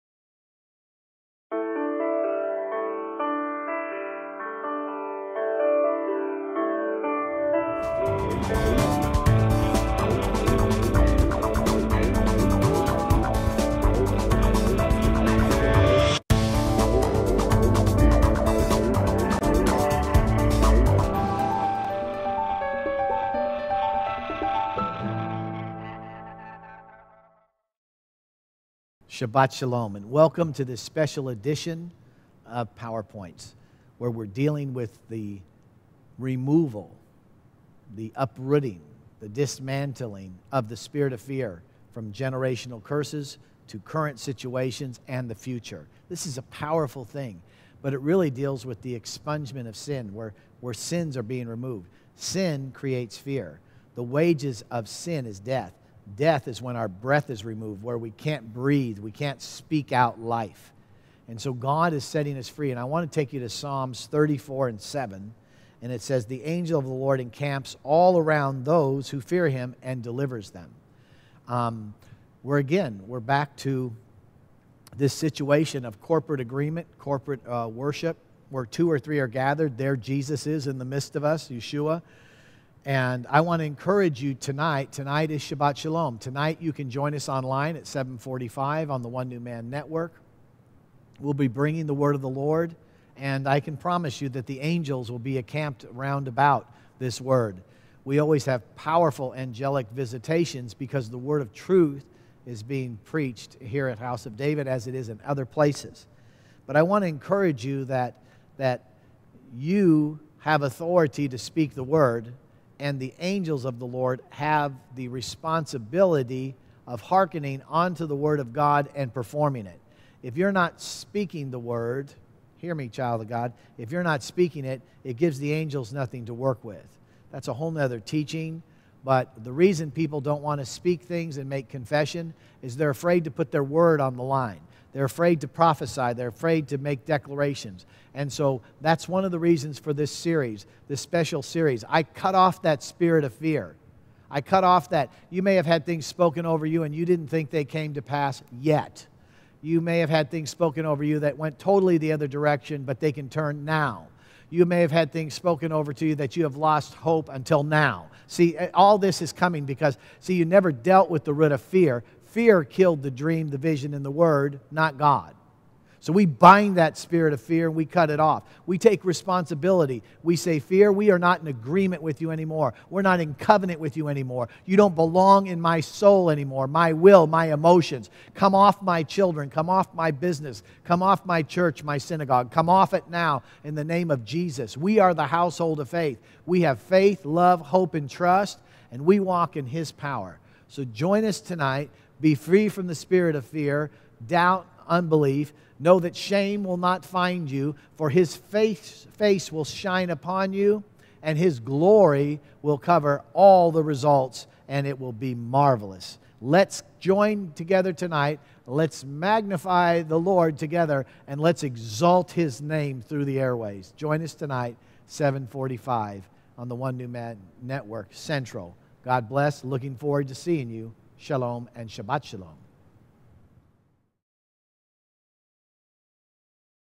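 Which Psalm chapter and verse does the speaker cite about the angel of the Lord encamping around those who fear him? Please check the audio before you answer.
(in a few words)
Psalms 34:7.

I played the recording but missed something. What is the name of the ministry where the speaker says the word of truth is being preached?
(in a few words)
House of David.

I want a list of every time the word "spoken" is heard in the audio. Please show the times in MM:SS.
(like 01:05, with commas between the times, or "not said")
02:26, 02:30, 02:35.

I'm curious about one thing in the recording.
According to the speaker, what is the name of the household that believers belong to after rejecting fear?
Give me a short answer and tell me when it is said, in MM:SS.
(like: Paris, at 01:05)
the household of faith, at 03:05.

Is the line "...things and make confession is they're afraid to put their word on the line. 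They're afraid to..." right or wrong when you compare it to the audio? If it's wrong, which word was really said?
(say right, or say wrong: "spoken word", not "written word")
right.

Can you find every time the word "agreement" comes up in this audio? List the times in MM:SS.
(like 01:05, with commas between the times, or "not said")
01:16, 02:51.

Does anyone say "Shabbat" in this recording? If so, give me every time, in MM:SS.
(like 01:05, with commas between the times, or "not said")
00:29, 01:25, 03:41.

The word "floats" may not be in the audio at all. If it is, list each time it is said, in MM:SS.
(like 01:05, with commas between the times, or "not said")
not said.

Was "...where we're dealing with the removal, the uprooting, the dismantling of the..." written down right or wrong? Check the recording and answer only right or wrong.
right.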